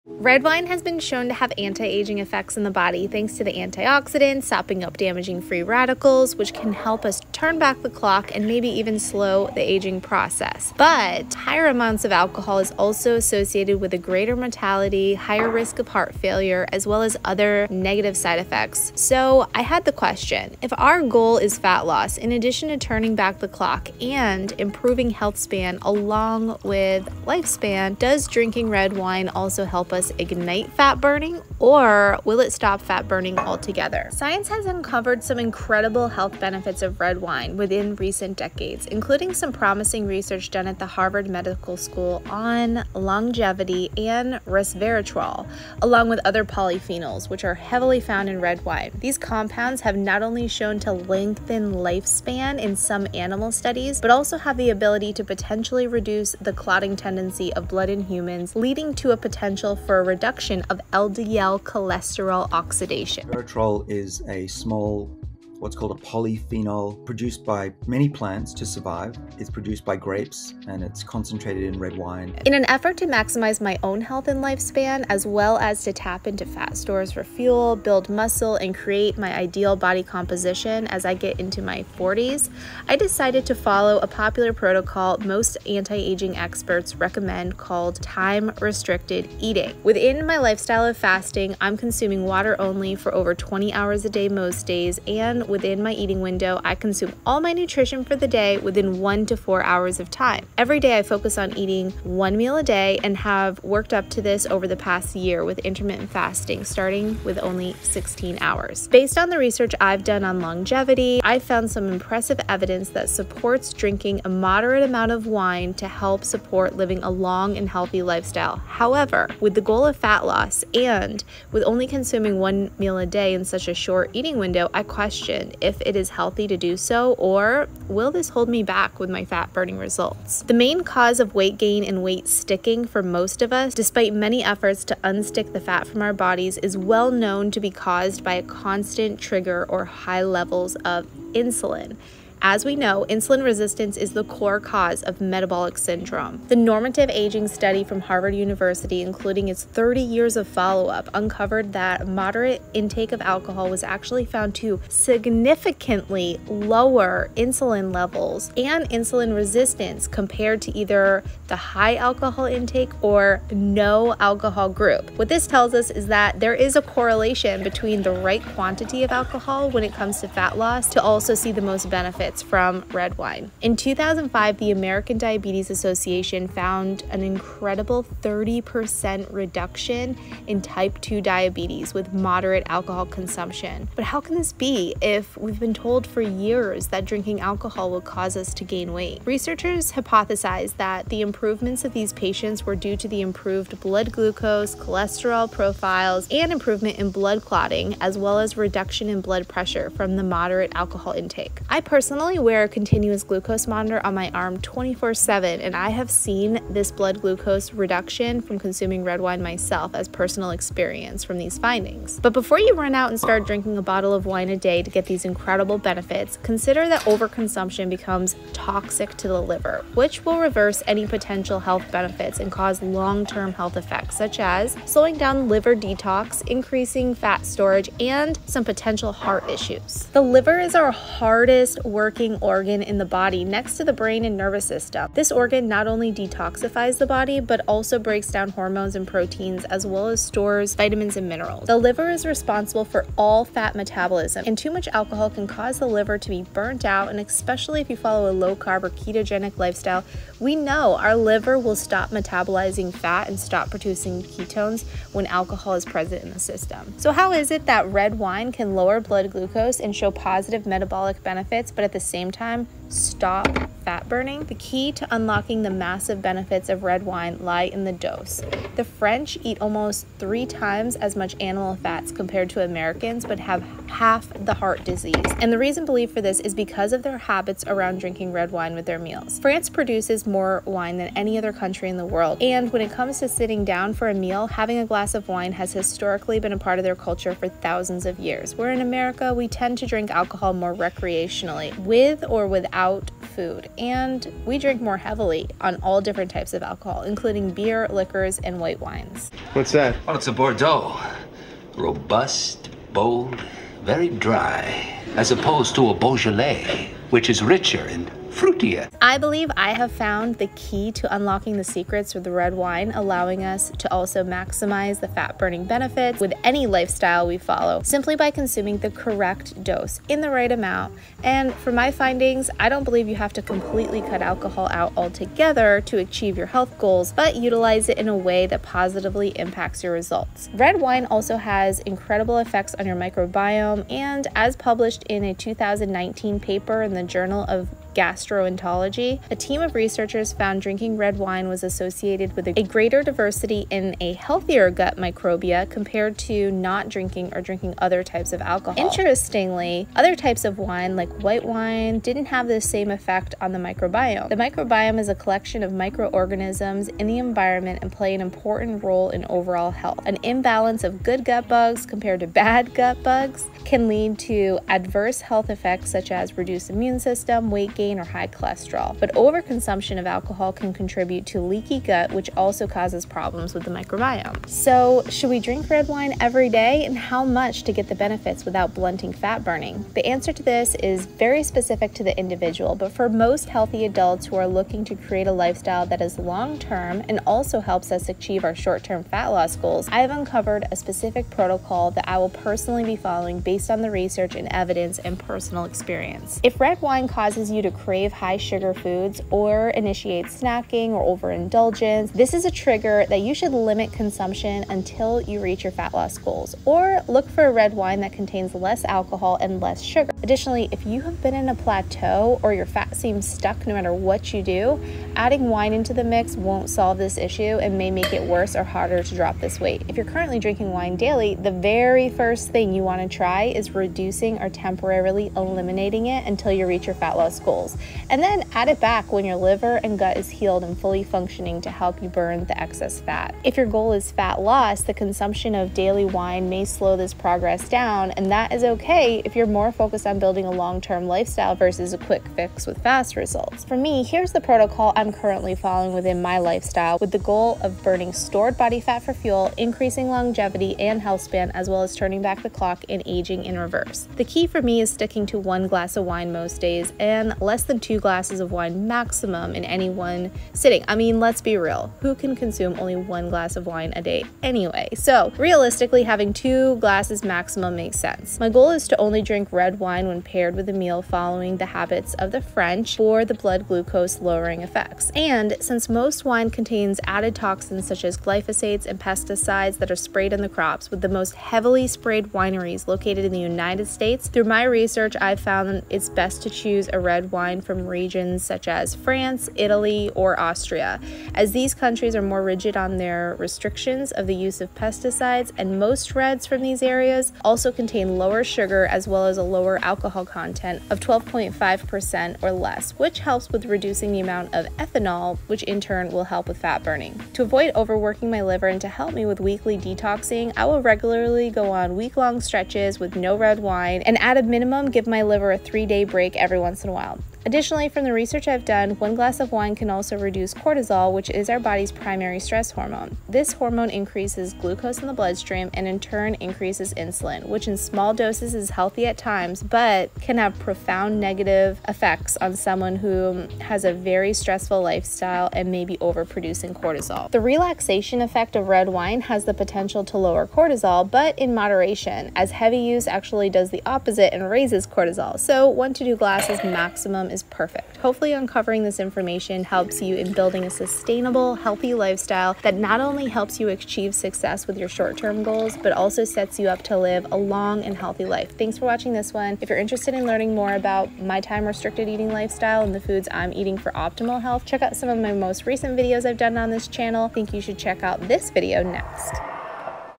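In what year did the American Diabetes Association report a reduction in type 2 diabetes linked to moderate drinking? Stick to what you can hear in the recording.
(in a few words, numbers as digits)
2005.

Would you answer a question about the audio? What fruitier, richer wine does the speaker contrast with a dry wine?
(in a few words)
Beaujolais.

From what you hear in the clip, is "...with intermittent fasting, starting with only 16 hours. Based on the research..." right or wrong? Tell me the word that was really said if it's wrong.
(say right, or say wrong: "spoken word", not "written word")
right.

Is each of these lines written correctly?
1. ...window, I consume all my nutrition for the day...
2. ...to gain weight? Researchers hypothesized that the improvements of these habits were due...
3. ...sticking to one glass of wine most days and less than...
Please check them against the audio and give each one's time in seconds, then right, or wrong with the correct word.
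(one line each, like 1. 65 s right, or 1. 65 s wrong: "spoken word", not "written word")
1. 96 s right
2. 188 s wrong: "patients", not "habits"
3. 454 s right.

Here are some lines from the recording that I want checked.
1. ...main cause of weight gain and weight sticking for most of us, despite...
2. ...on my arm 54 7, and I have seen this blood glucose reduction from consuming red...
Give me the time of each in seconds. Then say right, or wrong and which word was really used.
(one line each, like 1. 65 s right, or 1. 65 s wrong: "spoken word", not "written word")
1. 130 s right
2. 204 s wrong: "24", not "54".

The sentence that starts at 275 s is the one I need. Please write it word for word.
And the reason believed for this is because of their habits around drinking red wine with their meals.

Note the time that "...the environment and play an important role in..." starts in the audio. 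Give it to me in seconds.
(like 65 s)
357 s.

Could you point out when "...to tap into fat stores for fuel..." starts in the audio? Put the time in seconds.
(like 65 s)
75 s.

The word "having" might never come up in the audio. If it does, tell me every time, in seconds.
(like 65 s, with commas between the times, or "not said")
284 s, 466 s.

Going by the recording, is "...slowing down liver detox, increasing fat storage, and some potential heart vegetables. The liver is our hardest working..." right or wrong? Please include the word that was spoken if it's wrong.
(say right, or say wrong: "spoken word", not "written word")
wrong: "issues", not "vegetables".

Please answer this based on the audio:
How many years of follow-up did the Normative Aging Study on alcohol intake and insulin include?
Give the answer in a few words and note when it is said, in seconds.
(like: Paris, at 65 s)
30 years, at 149 s.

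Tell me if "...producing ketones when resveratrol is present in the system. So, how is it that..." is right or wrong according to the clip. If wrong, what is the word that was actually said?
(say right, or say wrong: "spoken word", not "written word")
wrong: "alcohol", not "resveratrol".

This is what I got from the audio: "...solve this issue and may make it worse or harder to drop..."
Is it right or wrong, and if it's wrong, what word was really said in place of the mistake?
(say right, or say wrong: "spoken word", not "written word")
right.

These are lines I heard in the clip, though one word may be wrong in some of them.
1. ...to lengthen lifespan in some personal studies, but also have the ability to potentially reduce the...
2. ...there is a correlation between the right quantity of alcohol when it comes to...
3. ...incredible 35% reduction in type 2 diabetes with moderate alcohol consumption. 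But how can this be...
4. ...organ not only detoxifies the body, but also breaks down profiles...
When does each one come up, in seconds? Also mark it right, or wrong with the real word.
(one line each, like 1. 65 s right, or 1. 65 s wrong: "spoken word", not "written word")
1. 50 s wrong: "animal", not "personal"
2. 166 s right
3. 177 s wrong: "30", not "35"
4. 235 s wrong: "hormones", not "profiles".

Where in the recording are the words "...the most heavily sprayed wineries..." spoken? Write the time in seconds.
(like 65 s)
481 s.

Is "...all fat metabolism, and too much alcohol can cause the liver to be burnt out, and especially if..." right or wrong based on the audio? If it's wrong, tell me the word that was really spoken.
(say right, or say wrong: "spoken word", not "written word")
right.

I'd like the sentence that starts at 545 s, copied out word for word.
So, one to two glasses maximum is perfect.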